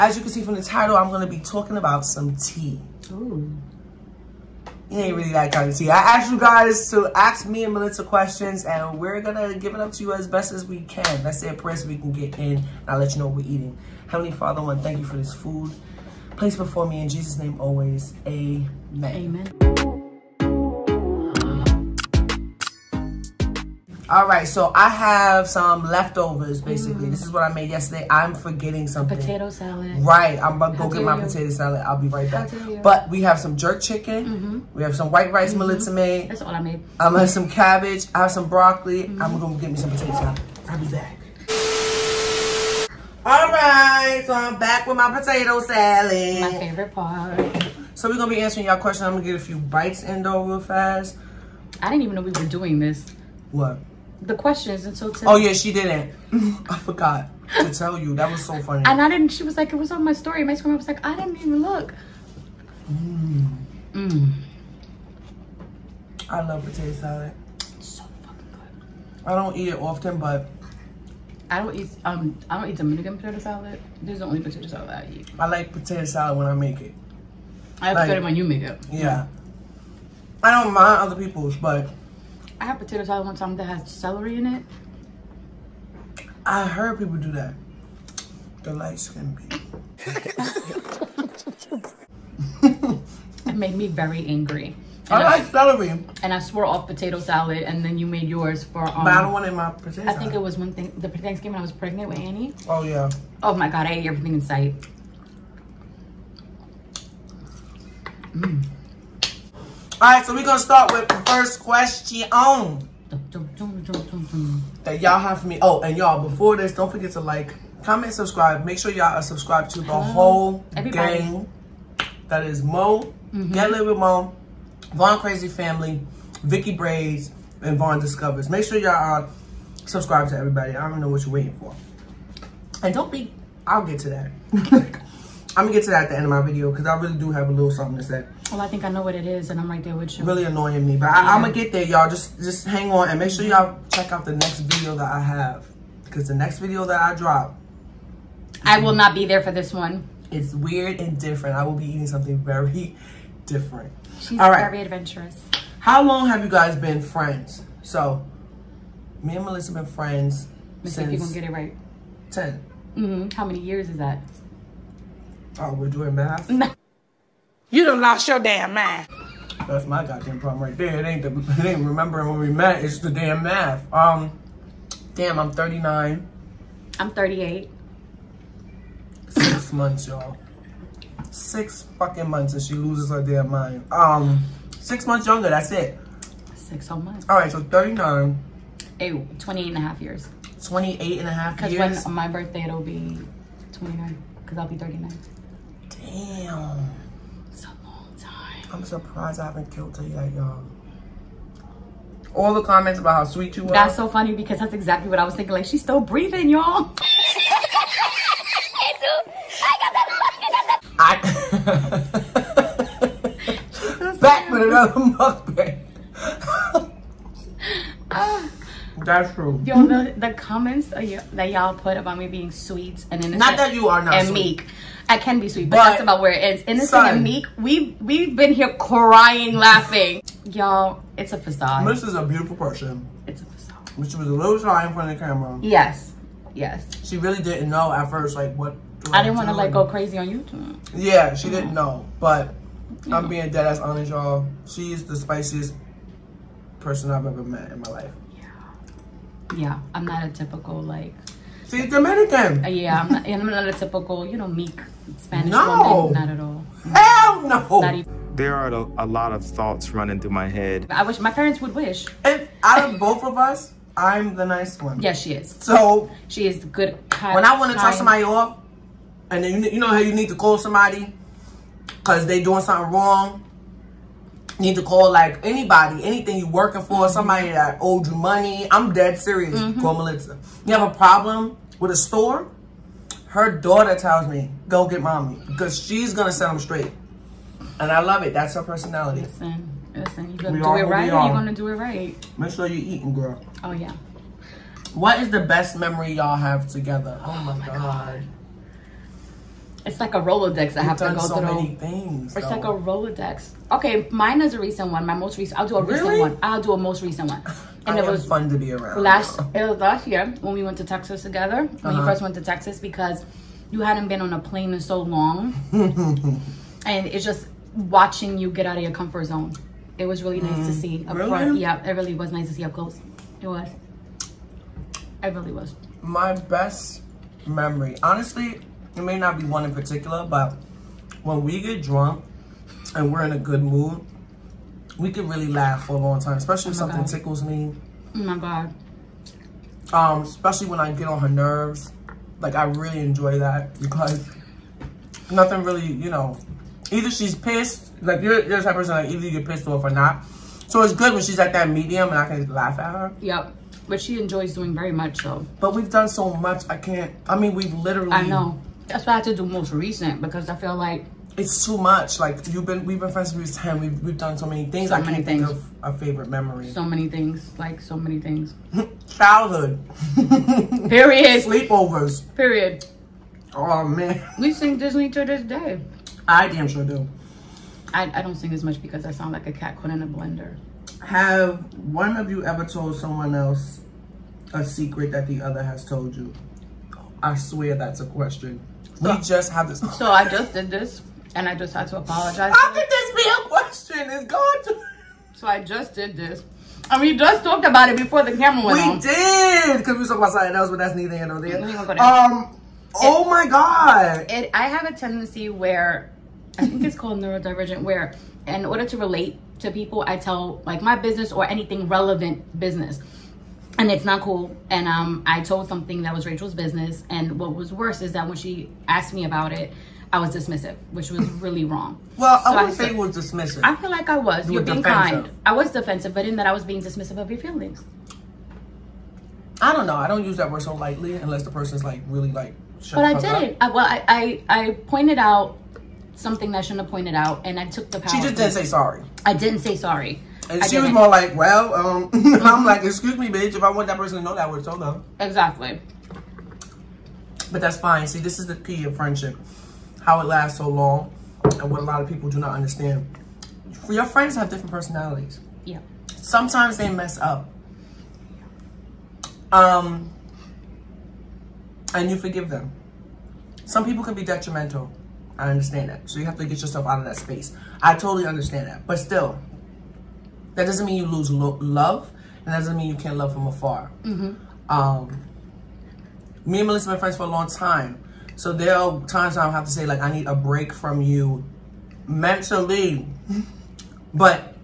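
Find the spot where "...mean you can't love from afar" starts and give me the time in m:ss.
7:52.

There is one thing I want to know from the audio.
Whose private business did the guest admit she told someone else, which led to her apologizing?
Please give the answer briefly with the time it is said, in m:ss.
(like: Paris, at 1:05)
Rachel, at 6:56.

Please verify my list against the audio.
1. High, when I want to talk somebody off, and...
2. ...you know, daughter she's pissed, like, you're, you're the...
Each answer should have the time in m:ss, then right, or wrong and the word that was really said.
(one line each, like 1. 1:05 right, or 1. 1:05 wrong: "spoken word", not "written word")
1. 4:27 right
2. 5:45 wrong: "either", not "daughter".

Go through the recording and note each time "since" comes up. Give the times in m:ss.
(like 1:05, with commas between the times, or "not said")
2:40, 6:03.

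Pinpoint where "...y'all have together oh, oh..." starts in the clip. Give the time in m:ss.
4:56.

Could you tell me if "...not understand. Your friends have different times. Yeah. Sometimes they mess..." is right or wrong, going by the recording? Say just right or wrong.
wrong.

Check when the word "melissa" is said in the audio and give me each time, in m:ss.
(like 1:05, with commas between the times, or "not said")
0:07, 2:39, 4:40, 7:56.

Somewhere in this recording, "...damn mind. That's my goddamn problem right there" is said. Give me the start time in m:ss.
2:48.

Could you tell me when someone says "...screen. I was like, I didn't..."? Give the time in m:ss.
1:00.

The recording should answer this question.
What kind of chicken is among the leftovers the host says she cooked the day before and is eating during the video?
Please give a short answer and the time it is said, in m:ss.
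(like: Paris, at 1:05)
jerk chicken, at 0:33.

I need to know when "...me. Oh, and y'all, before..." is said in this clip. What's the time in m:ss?
1:55.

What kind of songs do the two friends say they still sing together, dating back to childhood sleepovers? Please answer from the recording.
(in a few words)
Disney.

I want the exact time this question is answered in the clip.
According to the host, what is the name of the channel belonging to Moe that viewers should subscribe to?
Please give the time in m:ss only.
2:03.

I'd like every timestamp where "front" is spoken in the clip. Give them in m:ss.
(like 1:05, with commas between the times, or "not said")
3:54, 5:21.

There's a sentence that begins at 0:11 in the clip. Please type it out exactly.
Let's say a so we can get in and I'll let you know what we're eating.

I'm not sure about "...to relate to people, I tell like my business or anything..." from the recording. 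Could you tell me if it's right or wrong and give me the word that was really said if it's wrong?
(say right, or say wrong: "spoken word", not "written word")
right.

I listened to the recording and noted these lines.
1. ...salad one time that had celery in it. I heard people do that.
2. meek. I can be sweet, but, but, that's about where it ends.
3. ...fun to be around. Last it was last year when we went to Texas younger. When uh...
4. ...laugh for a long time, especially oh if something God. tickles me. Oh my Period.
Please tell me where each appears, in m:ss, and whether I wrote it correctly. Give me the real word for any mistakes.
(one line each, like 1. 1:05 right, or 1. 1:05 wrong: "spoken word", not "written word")
1. 1:23 right
2. 3:44 right
3. 5:08 wrong: "together", not "younger"
4. 5:35 wrong: "God", not "Period".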